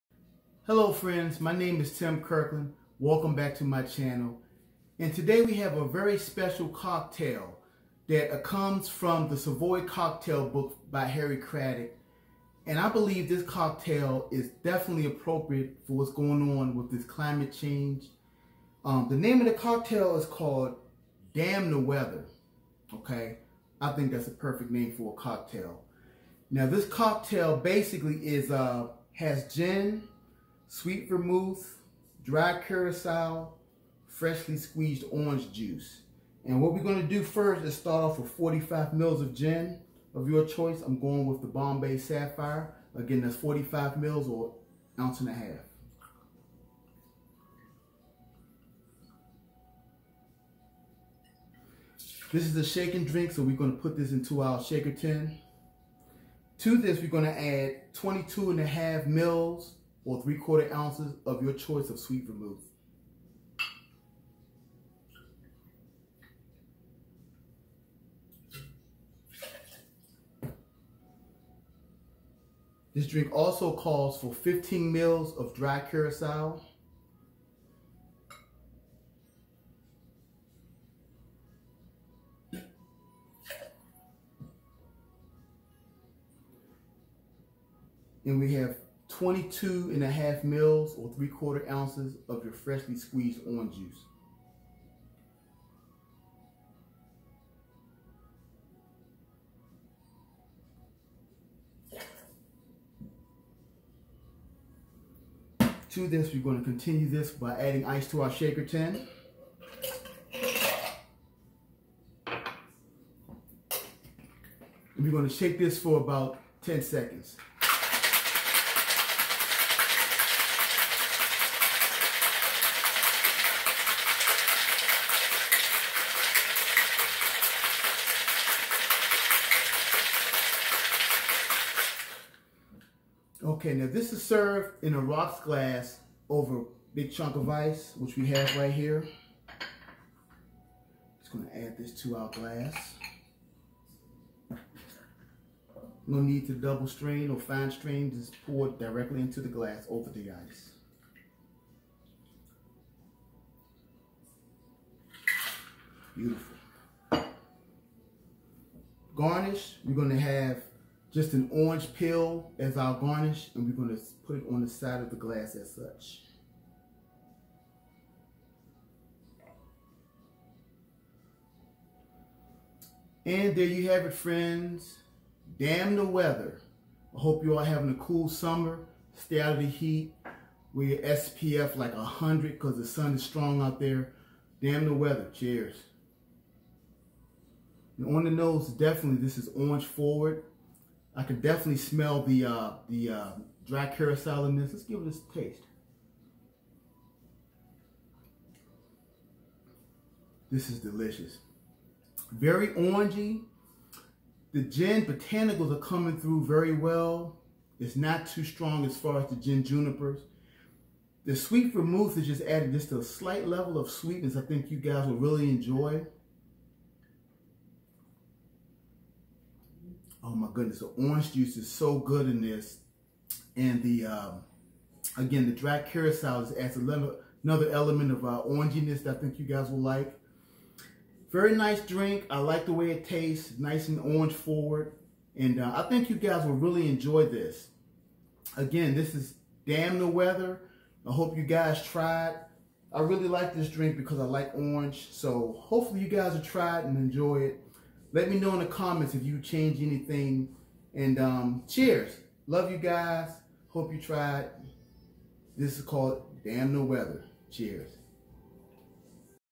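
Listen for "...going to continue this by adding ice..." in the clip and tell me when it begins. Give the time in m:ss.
1:46.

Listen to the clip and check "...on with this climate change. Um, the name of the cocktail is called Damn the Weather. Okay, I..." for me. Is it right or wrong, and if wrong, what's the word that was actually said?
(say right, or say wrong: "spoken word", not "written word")
right.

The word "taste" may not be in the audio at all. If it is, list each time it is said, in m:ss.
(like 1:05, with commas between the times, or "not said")
3:15, 3:53.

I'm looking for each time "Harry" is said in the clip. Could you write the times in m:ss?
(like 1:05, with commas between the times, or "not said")
0:11.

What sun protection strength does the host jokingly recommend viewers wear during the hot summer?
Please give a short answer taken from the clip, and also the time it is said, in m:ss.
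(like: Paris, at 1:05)
SPF 100, at 3:00.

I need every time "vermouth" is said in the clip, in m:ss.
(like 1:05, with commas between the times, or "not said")
0:31, 1:02, 3:31.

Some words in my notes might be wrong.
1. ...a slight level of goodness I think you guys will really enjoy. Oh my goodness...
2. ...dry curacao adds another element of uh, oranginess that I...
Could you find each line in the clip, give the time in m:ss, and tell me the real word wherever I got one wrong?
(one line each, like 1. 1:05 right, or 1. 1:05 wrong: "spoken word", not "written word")
1. 3:32 wrong: "sweetness", not "goodness"
2. 3:45 right.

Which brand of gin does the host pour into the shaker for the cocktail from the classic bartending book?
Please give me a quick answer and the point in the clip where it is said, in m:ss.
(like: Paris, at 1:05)
Bombay Sapphire, at 0:41.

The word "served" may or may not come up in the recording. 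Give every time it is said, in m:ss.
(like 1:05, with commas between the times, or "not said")
2:14.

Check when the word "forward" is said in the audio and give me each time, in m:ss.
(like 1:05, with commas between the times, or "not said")
3:09, 3:54.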